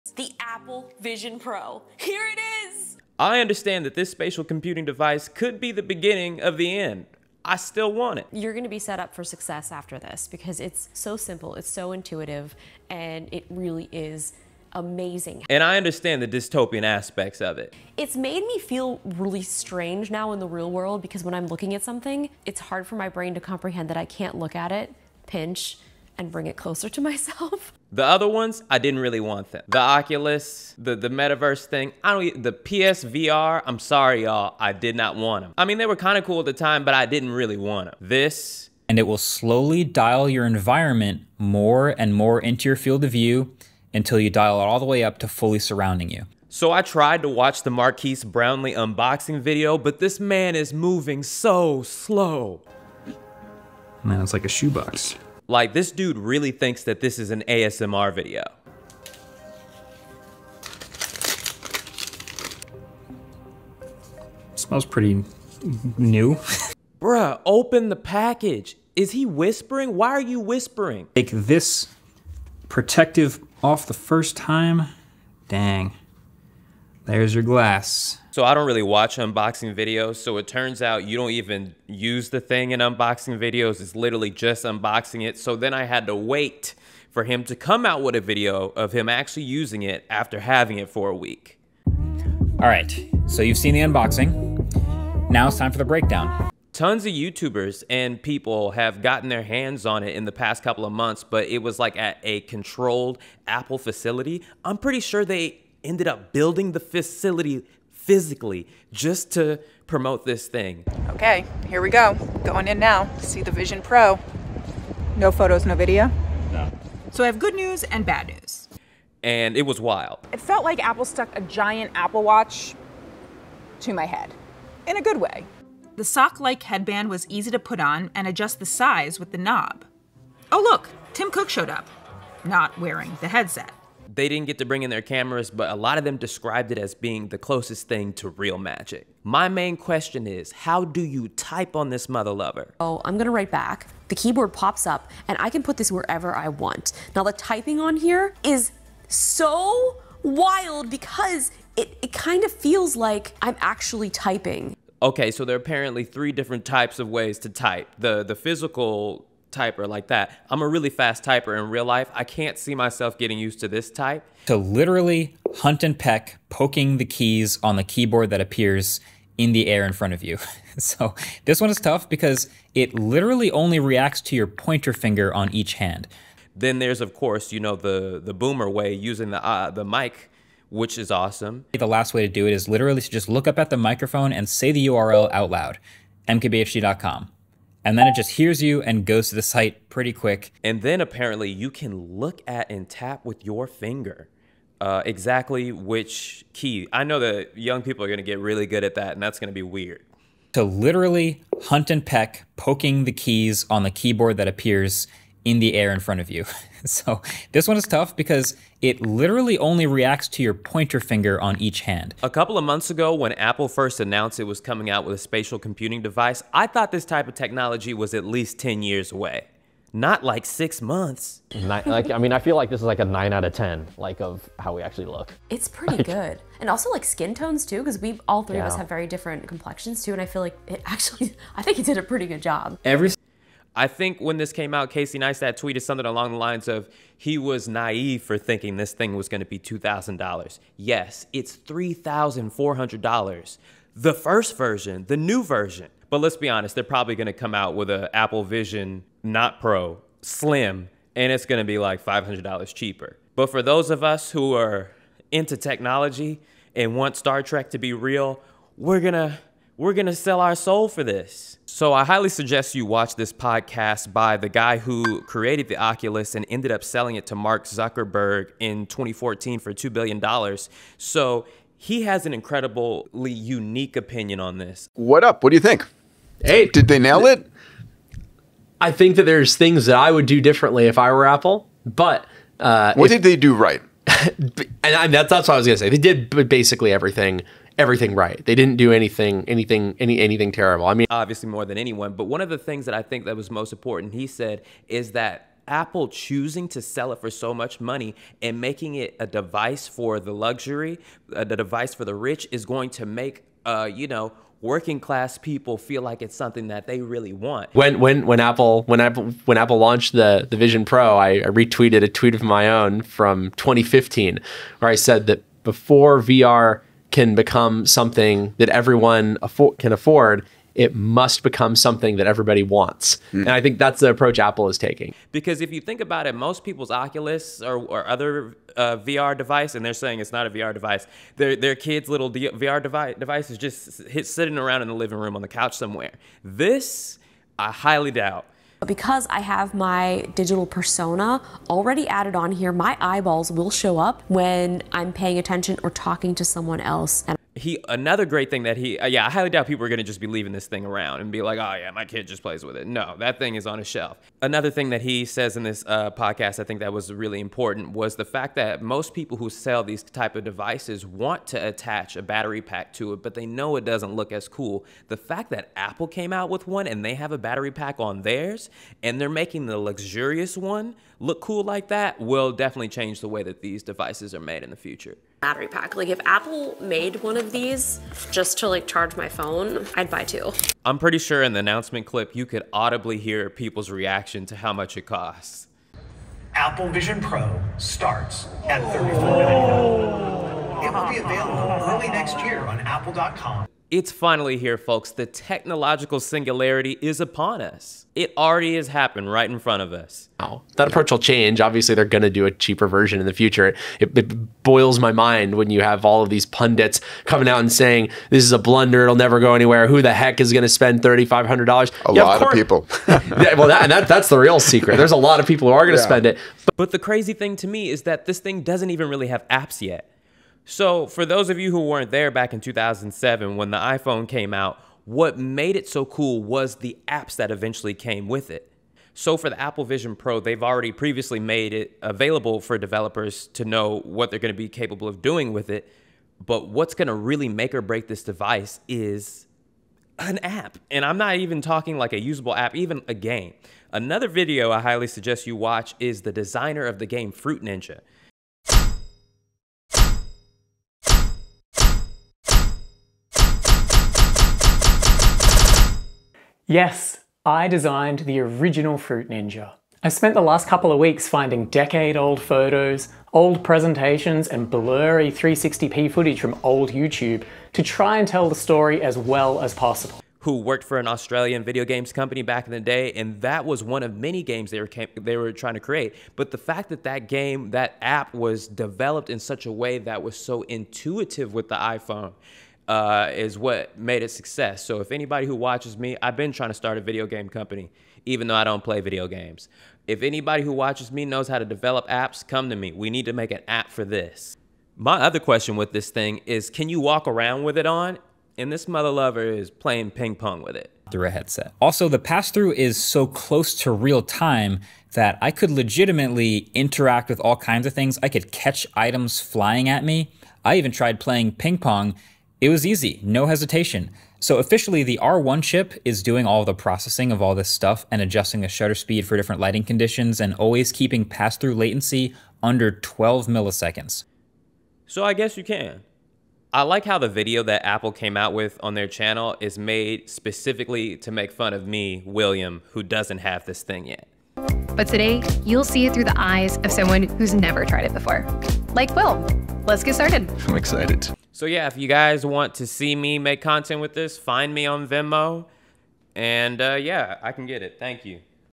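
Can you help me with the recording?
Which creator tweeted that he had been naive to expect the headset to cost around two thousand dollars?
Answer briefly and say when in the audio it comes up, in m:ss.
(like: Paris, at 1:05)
Casey Neistat, at 3:54.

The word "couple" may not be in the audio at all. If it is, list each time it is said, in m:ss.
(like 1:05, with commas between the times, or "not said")
1:40, 3:32, 7:40.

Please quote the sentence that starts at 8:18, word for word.
And this mother lover is playing ping pong with it.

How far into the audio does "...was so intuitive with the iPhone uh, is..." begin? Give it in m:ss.
8:00.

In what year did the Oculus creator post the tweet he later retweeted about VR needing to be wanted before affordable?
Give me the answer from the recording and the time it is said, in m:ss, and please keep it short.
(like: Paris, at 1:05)
2015, at 5:13.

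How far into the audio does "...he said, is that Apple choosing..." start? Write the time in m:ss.
4:54.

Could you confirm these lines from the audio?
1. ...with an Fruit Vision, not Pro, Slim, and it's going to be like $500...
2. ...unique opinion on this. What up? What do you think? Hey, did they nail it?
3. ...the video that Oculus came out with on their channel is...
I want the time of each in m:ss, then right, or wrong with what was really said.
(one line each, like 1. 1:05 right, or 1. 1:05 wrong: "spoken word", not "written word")
1. 4:07 wrong: "Apple", not "Fruit"
2. 4:33 right
3. 8:47 wrong: "Apple", not "Oculus".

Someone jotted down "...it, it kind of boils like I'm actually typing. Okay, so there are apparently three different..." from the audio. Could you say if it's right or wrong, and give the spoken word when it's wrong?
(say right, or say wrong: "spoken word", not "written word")
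wrong: "feels", not "boils".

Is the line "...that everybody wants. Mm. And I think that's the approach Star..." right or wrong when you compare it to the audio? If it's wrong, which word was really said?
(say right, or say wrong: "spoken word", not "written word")
wrong: "Apple", not "Star".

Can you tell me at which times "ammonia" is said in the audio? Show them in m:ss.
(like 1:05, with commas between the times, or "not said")
not said.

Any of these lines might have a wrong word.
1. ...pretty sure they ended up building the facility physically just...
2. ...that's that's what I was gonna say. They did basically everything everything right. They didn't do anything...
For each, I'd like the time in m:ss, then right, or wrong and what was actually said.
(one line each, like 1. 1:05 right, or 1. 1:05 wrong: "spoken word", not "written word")
1. 1:44 right
2. 4:45 right.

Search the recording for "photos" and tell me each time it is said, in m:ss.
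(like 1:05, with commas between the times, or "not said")
1:55, 7:42.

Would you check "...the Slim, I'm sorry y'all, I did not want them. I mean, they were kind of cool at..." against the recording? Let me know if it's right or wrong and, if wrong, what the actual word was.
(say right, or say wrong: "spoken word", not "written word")
wrong: "PSVR", not "Slim".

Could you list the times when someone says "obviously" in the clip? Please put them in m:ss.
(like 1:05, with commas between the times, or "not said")
4:51, 6:41.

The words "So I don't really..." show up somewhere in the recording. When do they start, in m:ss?
1:18.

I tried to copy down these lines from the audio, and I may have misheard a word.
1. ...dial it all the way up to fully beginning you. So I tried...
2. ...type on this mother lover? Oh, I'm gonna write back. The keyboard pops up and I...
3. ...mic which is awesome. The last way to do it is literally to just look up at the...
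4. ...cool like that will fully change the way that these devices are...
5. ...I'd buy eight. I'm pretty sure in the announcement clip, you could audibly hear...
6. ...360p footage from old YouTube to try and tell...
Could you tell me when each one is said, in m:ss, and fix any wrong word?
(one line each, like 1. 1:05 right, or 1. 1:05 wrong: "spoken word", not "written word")
1. 0:44 wrong: "surrounding", not "beginning"
2. 2:21 right
3. 2:59 right
4. 6:11 wrong: "definitely", not "fully"
5. 6:19 wrong: "two", not "eight"
6. 7:45 right.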